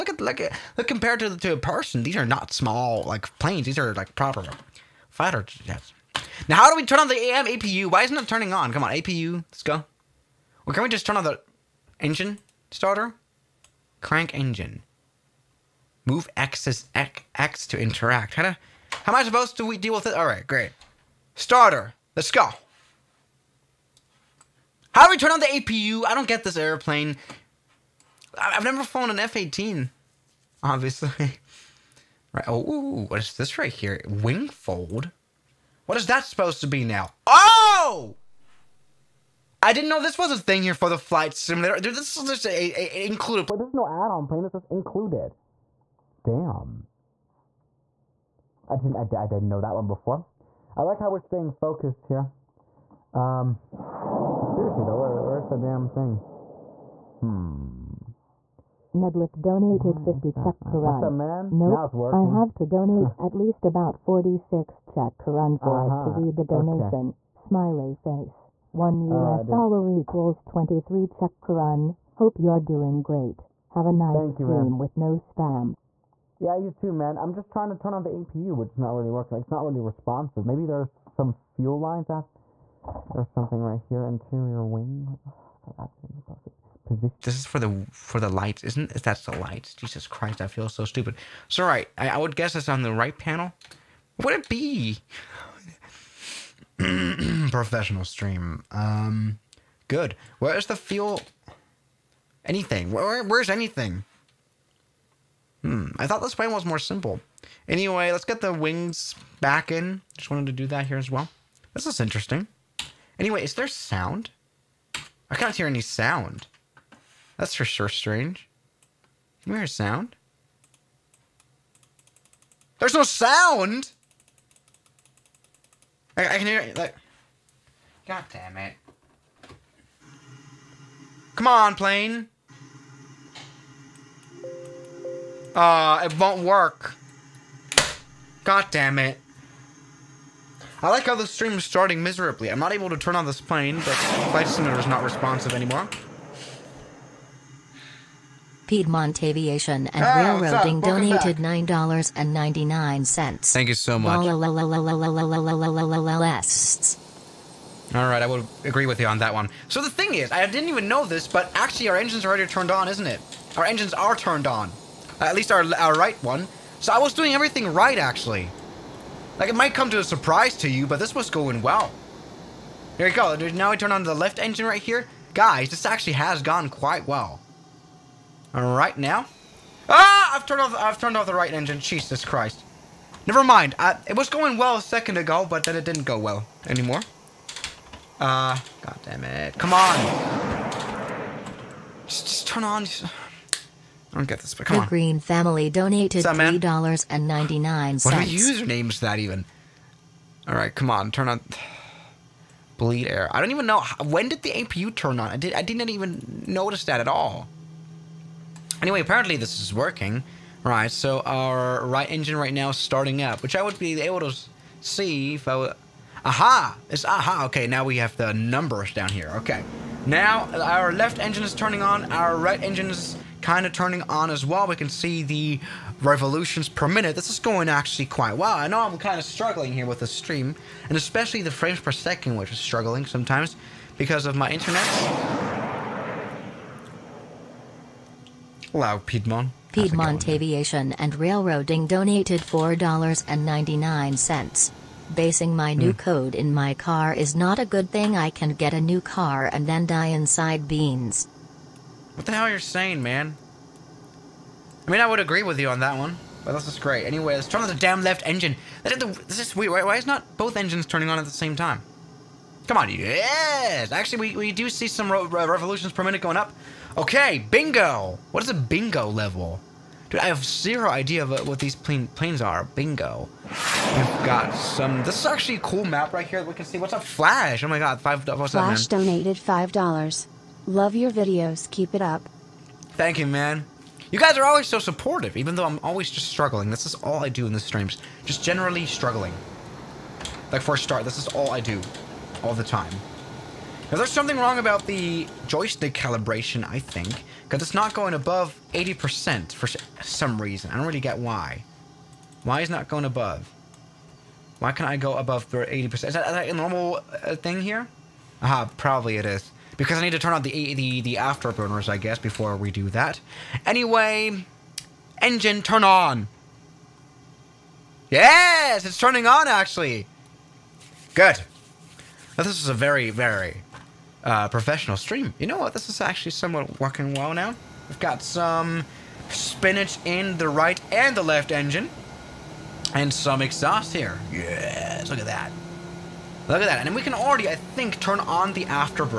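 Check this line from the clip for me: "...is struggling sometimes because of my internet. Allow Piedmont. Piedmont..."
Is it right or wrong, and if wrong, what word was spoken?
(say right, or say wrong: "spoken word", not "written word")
right.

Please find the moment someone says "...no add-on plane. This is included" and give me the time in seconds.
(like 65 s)
43 s.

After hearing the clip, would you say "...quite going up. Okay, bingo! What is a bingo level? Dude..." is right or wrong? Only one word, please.
wrong.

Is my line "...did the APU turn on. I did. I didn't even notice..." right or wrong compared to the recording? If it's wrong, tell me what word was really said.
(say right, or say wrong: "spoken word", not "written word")
right.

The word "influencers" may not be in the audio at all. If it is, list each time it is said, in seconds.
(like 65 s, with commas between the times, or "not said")
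not said.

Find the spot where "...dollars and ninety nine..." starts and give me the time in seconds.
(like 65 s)
196 s.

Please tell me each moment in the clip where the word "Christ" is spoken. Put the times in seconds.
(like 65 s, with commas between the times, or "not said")
90 s, 182 s.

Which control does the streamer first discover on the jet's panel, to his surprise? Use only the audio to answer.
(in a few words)
Wing fold.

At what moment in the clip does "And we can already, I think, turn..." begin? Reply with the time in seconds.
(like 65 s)
336 s.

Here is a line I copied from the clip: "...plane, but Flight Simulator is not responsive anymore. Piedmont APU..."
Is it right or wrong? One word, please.
wrong.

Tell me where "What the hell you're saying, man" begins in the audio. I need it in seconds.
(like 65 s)
252 s.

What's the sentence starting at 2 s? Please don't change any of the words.
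These are not small like planes.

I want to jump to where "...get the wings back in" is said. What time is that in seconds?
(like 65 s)
108 s.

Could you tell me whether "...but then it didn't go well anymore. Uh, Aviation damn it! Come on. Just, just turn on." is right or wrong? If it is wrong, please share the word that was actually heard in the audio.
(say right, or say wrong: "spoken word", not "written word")
wrong: "God", not "Aviation".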